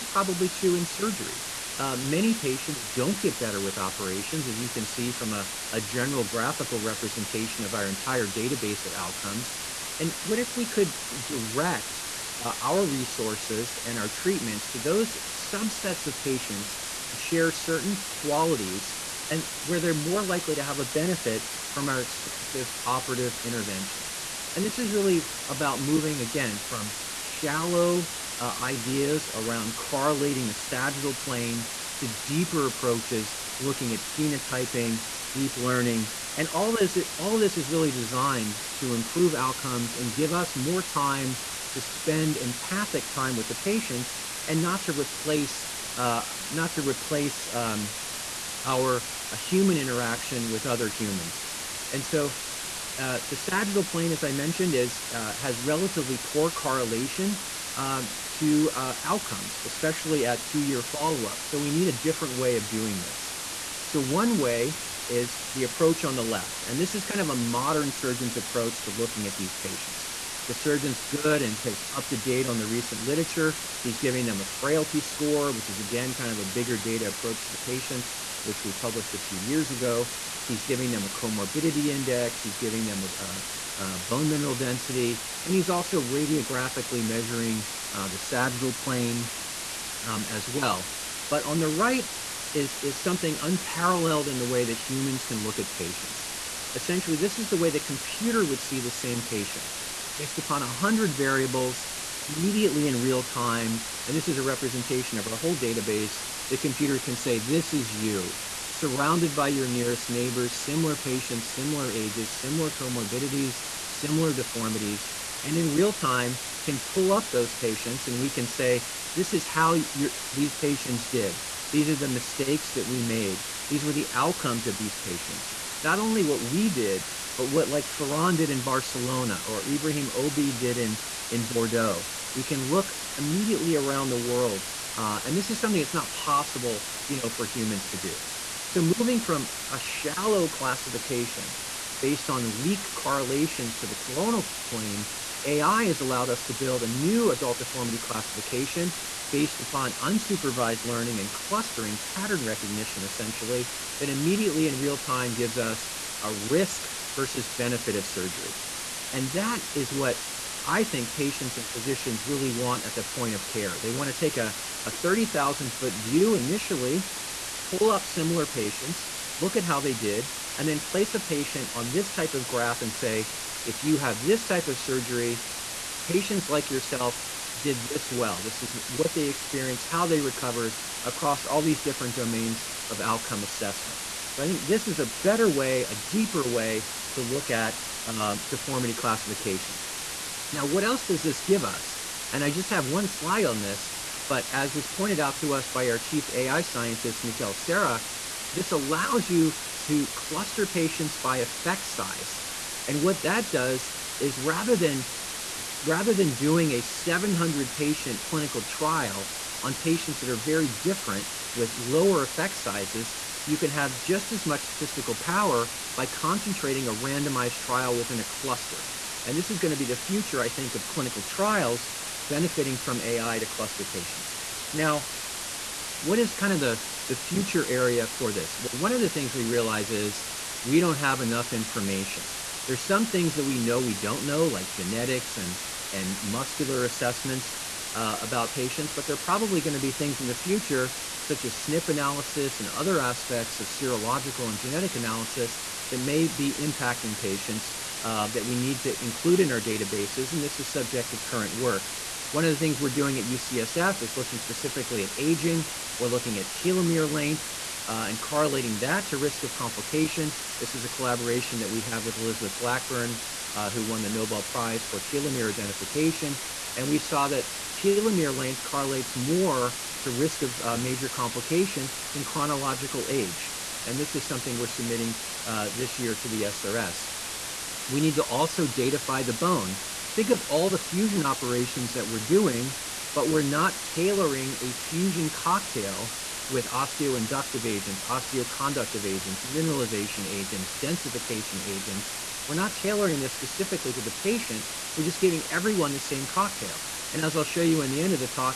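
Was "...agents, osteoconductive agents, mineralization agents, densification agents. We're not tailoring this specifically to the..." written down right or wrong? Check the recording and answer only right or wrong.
right.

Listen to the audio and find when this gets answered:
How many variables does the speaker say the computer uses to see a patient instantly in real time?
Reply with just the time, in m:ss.
1:40.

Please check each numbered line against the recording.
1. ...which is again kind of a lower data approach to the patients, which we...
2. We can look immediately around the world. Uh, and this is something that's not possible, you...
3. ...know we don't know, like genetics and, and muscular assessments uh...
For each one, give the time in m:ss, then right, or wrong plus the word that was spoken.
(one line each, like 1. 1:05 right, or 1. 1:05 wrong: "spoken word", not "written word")
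1. 1:15 wrong: "bigger", not "lower"
2. 2:12 right
3. 3:53 right.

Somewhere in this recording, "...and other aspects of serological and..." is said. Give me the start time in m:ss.
4:02.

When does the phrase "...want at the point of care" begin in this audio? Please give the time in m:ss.
2:42.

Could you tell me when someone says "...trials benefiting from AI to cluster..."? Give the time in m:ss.
3:41.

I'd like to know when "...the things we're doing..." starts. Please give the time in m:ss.
4:12.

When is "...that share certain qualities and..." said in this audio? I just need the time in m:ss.
0:17.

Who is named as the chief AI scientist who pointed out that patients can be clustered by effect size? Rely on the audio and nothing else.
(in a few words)
Miquel Serra.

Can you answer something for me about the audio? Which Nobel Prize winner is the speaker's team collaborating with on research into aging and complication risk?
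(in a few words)
Elizabeth Blackburn.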